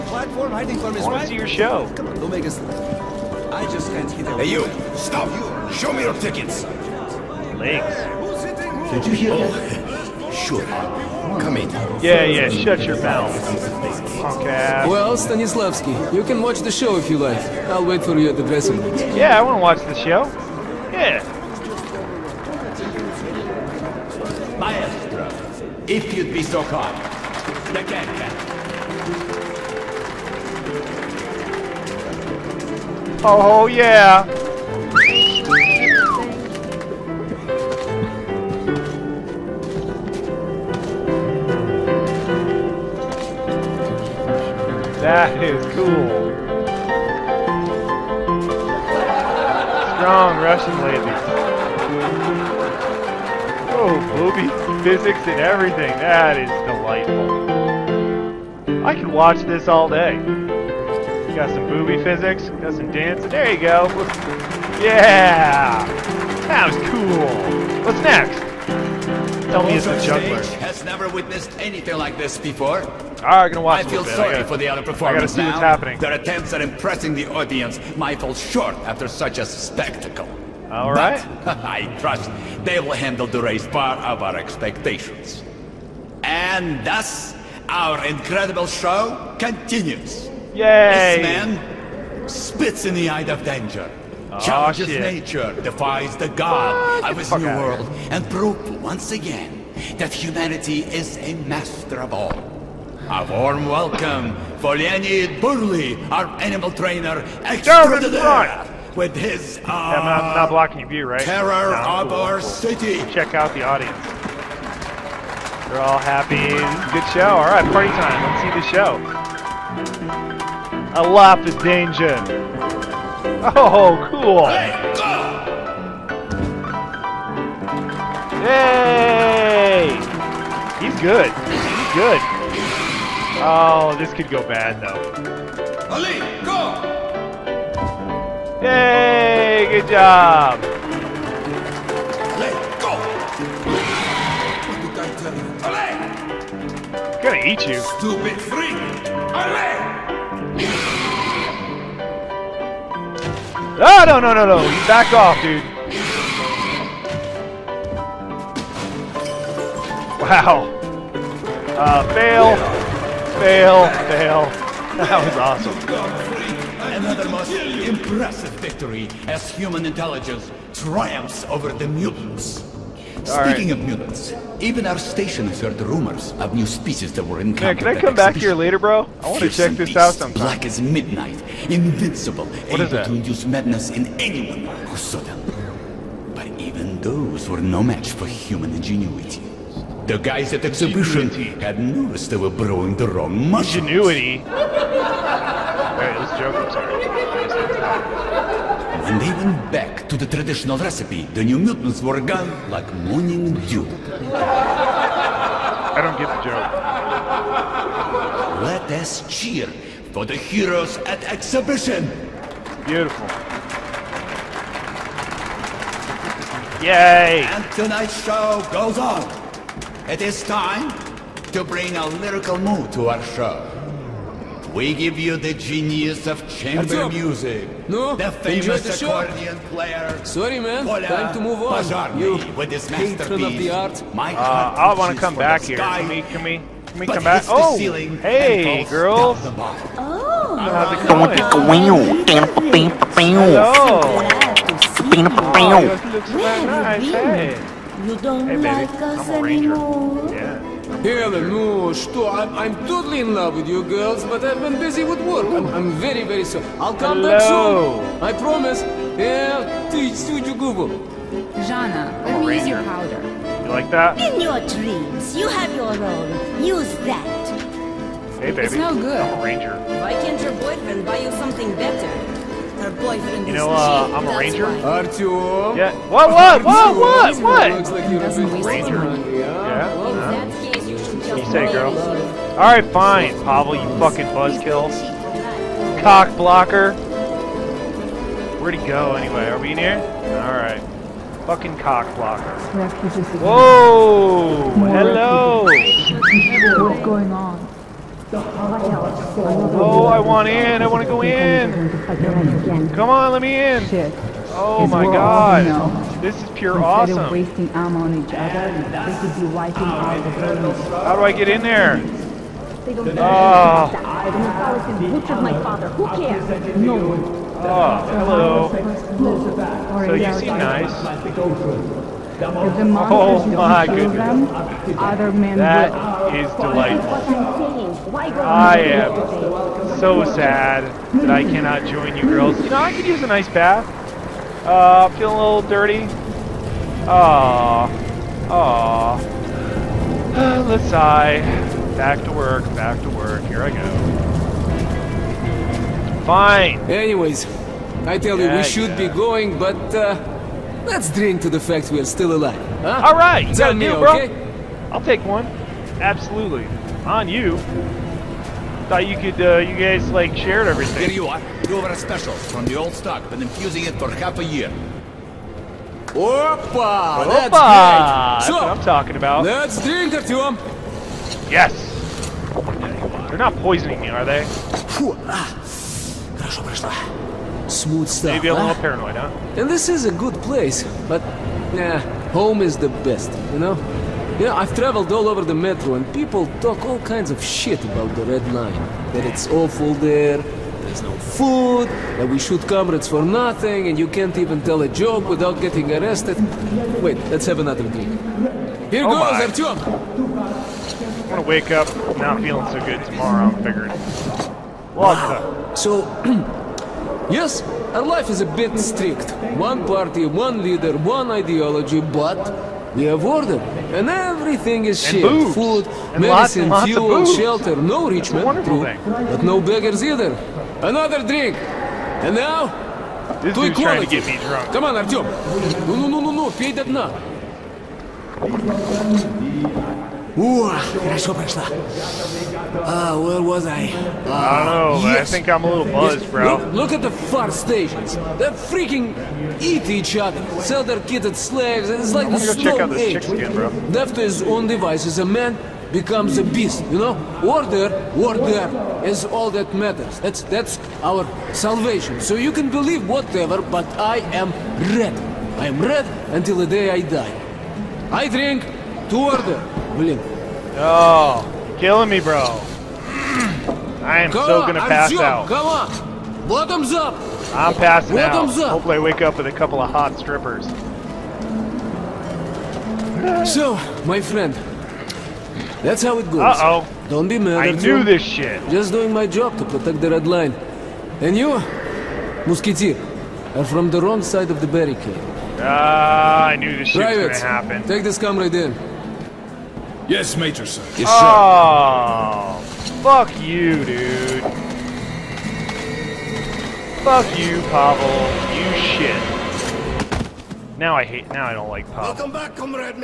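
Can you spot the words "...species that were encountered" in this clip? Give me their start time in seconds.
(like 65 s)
176 s.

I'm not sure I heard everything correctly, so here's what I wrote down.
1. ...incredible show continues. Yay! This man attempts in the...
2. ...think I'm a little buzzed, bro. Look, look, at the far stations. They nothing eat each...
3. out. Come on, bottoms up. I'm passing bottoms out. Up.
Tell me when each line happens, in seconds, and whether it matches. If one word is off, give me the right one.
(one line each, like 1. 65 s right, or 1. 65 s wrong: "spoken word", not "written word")
1. 88 s wrong: "spits", not "attempts"
2. 435 s wrong: "freaking", not "nothing"
3. 465 s right.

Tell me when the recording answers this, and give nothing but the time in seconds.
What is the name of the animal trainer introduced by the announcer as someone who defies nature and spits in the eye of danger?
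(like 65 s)
104 s.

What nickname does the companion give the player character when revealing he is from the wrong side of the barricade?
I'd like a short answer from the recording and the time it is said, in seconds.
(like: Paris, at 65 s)
Musketeer, at 482 s.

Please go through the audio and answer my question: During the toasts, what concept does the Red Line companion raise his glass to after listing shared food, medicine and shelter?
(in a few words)
equality.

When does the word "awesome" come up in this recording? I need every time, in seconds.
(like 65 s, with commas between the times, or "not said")
165 s, 306 s.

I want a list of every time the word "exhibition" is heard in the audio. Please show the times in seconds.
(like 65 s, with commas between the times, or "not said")
190 s, 211 s.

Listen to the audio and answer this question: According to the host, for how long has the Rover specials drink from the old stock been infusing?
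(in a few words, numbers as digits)
half a year.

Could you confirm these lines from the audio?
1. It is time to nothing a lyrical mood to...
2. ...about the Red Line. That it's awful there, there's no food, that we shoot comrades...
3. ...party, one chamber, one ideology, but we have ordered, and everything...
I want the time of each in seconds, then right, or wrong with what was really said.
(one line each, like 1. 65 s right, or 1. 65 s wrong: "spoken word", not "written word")
1. 220 s wrong: "bring", not "nothing"
2. 387 s right
3. 409 s wrong: "leader", not "chamber".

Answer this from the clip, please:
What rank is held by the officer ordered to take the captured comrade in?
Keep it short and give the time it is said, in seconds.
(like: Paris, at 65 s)
Major, at 490 s.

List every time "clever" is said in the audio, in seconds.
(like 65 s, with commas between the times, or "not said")
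not said.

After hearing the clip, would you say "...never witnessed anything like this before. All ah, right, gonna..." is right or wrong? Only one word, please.
right.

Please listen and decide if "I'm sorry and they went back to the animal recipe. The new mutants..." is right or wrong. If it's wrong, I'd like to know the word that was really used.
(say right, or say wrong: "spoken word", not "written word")
wrong: "traditional", not "animal".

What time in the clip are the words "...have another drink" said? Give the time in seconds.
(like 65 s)
397 s.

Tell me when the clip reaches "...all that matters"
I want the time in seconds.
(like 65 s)
449 s.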